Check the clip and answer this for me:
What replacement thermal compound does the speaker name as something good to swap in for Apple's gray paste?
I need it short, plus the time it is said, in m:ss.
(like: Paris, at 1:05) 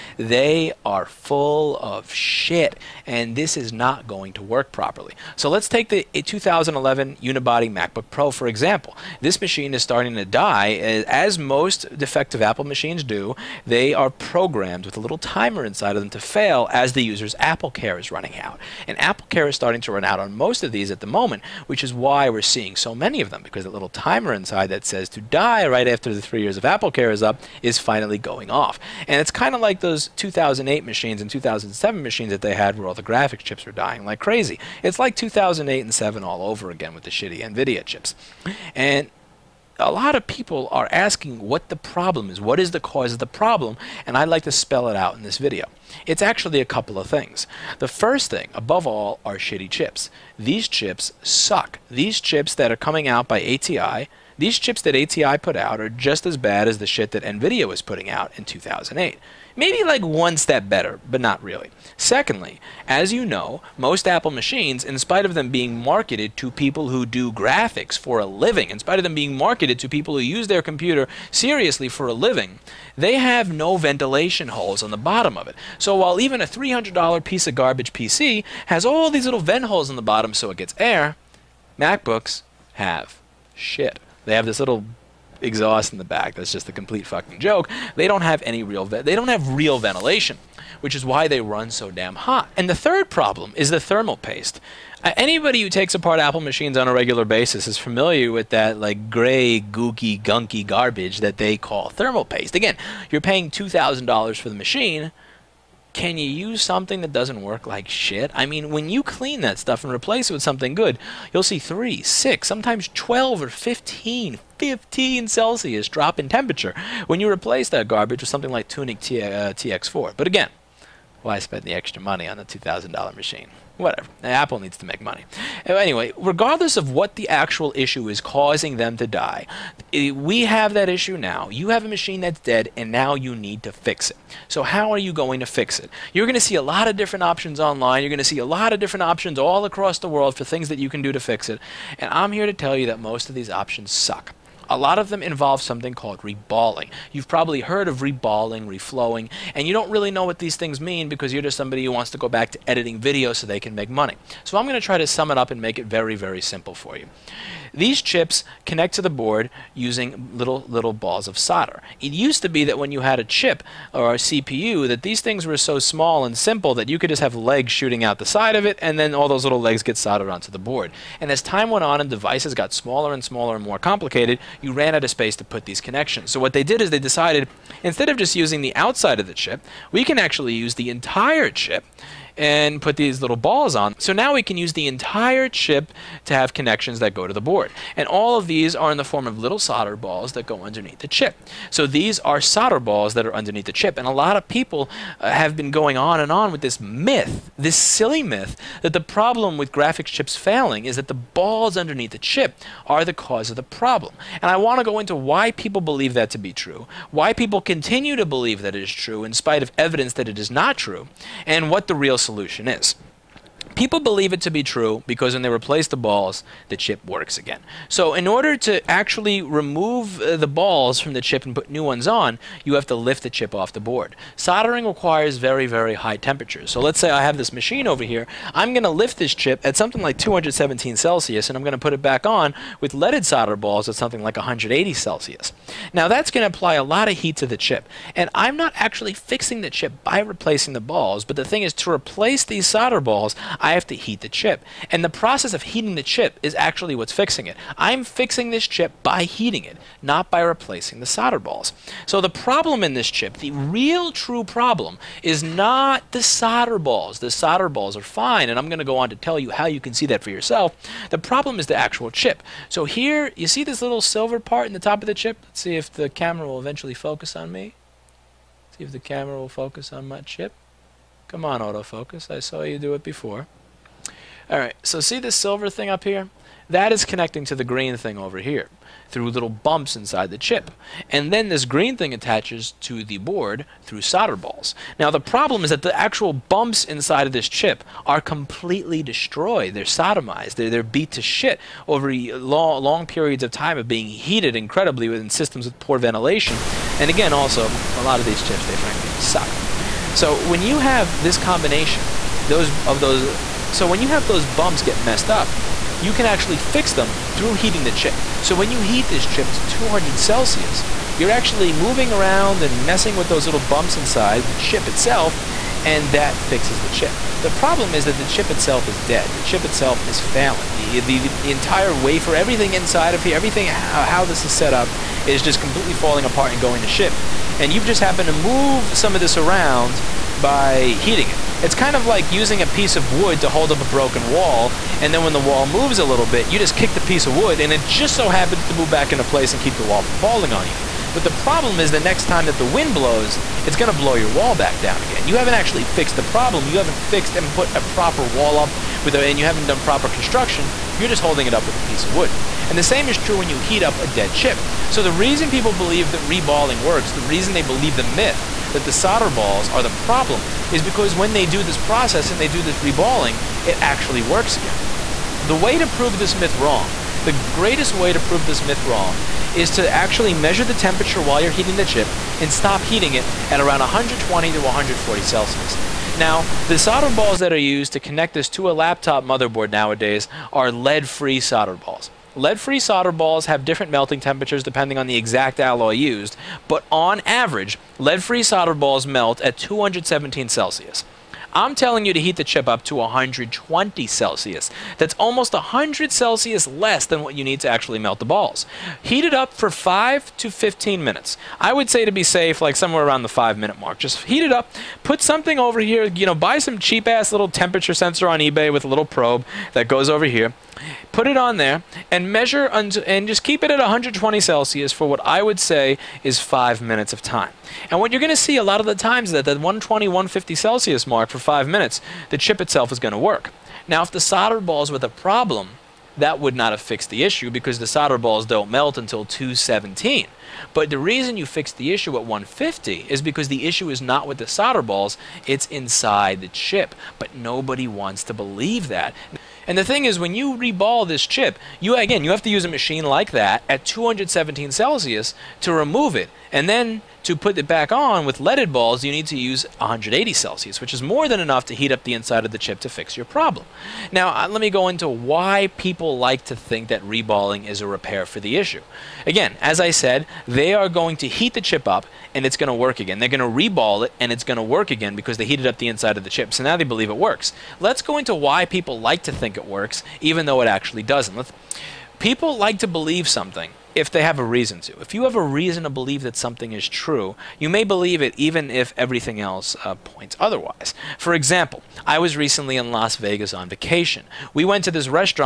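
Tuniq TX4, at 1:58.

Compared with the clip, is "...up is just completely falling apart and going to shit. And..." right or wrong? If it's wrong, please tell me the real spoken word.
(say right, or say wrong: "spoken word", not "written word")
right.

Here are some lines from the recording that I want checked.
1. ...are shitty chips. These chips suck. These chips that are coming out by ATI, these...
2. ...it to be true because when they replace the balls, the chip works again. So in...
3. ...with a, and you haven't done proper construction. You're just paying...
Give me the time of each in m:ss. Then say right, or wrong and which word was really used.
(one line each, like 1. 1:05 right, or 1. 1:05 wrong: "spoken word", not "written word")
1. 0:49 right
2. 3:34 right
3. 5:49 wrong: "holding", not "paying".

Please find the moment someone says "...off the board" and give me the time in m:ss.
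3:43.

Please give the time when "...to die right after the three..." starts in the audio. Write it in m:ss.
0:25.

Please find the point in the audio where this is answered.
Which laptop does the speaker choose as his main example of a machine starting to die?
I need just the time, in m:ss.
0:06.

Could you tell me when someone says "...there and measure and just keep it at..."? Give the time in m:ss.
6:51.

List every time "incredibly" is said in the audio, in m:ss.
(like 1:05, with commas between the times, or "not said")
4:54.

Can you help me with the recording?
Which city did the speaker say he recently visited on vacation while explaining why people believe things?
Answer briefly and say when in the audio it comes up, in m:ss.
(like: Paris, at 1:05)
Las Vegas, at 8:02.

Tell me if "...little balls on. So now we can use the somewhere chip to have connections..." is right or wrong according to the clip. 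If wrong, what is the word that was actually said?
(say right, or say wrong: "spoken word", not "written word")
wrong: "entire", not "somewhere".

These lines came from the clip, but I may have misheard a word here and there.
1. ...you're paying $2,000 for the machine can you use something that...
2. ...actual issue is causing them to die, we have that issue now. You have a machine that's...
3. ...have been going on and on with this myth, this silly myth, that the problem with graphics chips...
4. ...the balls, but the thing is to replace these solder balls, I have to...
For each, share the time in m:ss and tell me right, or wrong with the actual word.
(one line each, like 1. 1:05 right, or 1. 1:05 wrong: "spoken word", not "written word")
1. 1:43 right
2. 2:07 right
3. 3:15 right
4. 4:00 right.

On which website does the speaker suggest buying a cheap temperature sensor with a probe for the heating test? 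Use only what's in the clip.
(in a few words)
eBay.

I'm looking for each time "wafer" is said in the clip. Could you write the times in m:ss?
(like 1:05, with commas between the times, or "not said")
5:21.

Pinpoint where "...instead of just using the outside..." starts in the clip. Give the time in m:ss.
2:57.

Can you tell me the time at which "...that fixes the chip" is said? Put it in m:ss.
5:16.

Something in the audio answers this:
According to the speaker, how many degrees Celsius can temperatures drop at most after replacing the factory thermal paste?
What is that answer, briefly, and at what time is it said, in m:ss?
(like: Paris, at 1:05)
15, at 1:54.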